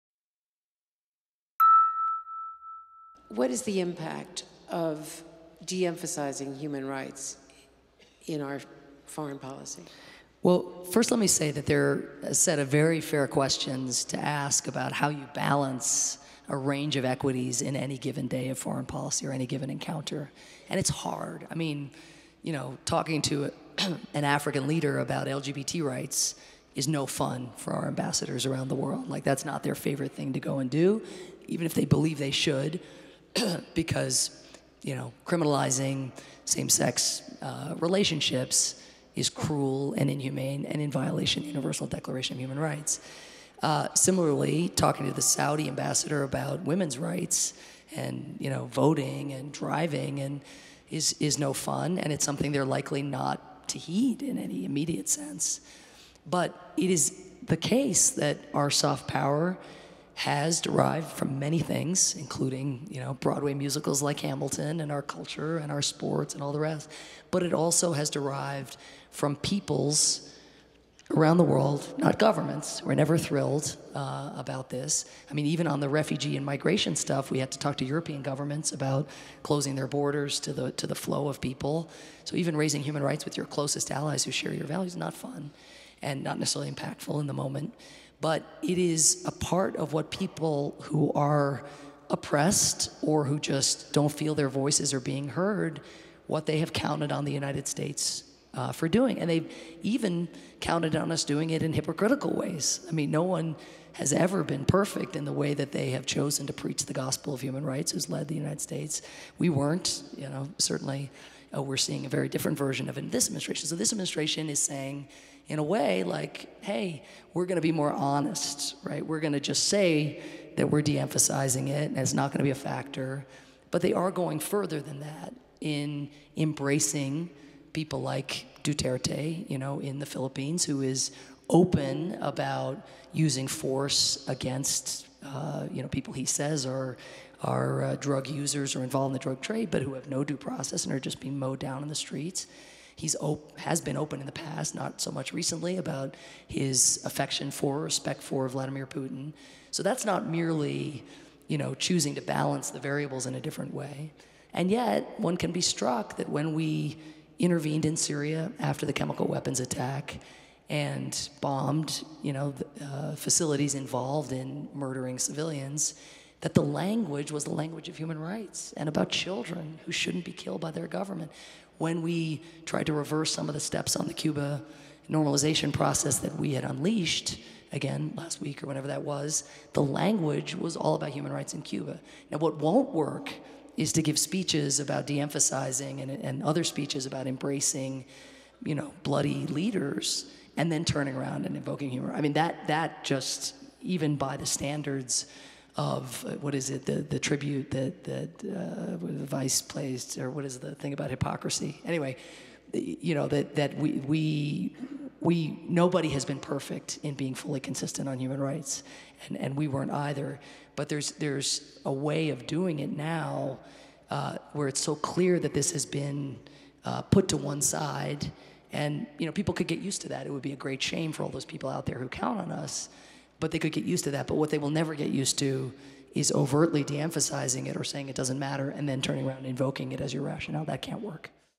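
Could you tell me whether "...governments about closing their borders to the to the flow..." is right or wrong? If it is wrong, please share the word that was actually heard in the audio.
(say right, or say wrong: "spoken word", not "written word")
right.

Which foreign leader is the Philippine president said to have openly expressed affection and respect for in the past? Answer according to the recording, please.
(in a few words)
Vladimir Putin.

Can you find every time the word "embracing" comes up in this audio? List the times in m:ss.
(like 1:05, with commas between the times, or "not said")
2:06, 3:07.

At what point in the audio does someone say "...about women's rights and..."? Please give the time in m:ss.
0:46.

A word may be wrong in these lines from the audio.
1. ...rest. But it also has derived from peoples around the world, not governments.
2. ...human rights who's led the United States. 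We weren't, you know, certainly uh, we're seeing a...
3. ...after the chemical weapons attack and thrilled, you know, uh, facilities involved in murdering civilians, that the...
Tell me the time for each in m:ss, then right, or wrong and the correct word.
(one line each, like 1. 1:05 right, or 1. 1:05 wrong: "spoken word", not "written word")
1. 1:06 right
2. 1:47 right
3. 2:38 wrong: "bombed", not "thrilled".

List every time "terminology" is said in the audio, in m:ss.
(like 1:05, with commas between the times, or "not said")
not said.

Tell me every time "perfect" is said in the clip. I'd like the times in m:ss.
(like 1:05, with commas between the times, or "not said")
1:44, 3:26.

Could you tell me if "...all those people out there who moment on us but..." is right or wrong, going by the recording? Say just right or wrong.
wrong.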